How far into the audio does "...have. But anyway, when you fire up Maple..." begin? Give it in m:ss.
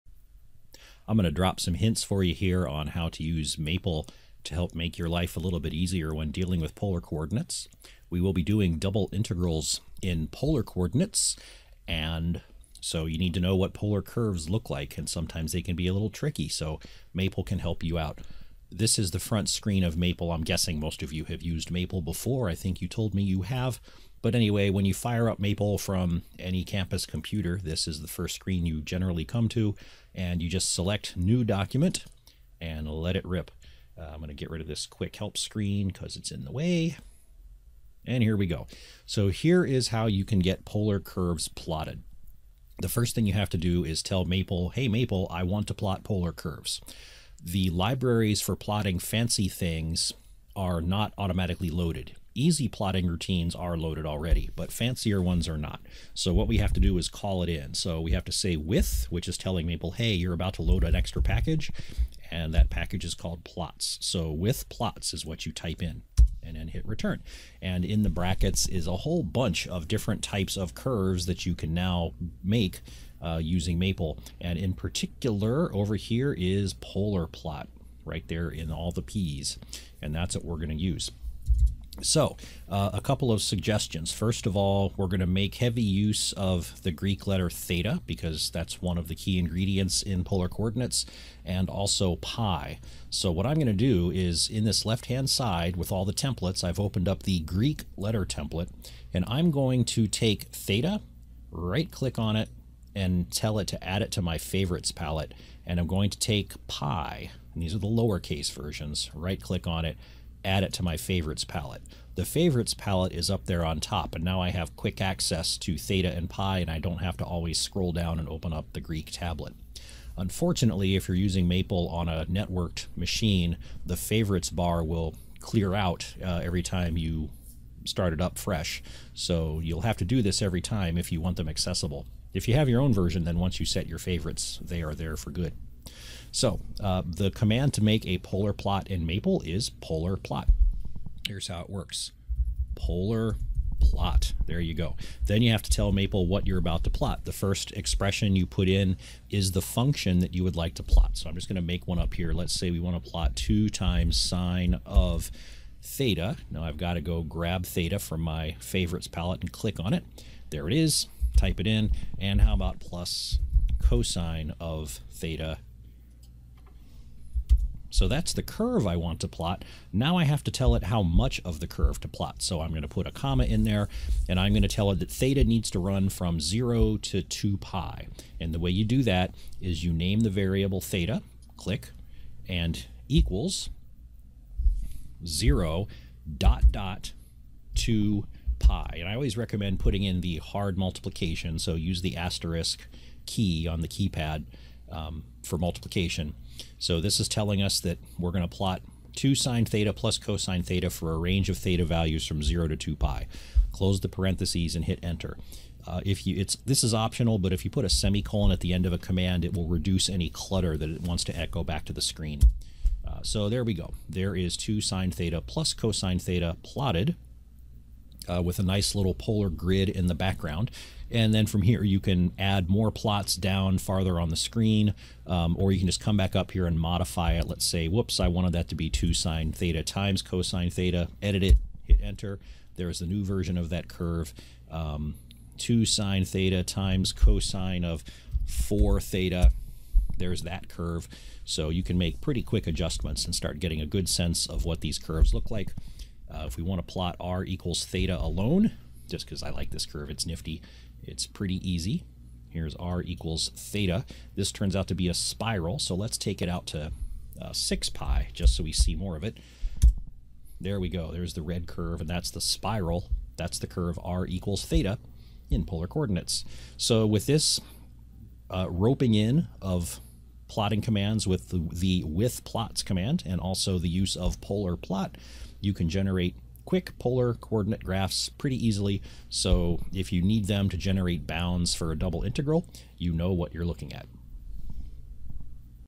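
0:23.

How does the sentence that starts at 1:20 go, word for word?
And that's what we're going to use.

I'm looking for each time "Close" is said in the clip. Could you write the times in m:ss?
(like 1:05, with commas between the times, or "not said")
3:23.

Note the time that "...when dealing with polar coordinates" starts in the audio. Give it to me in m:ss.
0:06.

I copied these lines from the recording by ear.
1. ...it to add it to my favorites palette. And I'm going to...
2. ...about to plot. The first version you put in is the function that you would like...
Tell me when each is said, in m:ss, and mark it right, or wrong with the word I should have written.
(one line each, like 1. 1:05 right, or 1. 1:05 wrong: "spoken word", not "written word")
1. 1:43 right
2. 2:26 wrong: "expression", not "version".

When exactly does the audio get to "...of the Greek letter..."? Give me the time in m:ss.
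1:26.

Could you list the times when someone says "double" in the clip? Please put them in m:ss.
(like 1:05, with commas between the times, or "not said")
0:08, 4:41.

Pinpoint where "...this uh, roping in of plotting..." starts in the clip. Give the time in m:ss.
4:27.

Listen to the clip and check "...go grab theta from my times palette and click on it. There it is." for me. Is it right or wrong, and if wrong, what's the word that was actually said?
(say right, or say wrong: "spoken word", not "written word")
wrong: "favorites", not "times".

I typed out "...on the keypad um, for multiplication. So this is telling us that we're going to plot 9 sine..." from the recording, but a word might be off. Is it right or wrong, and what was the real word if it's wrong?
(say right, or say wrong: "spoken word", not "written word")
wrong: "2", not "9".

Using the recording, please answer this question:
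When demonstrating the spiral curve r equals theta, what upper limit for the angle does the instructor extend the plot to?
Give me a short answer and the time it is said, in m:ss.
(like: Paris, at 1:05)
6 pi, at 4:17.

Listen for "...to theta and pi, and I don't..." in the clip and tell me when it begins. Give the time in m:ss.
1:55.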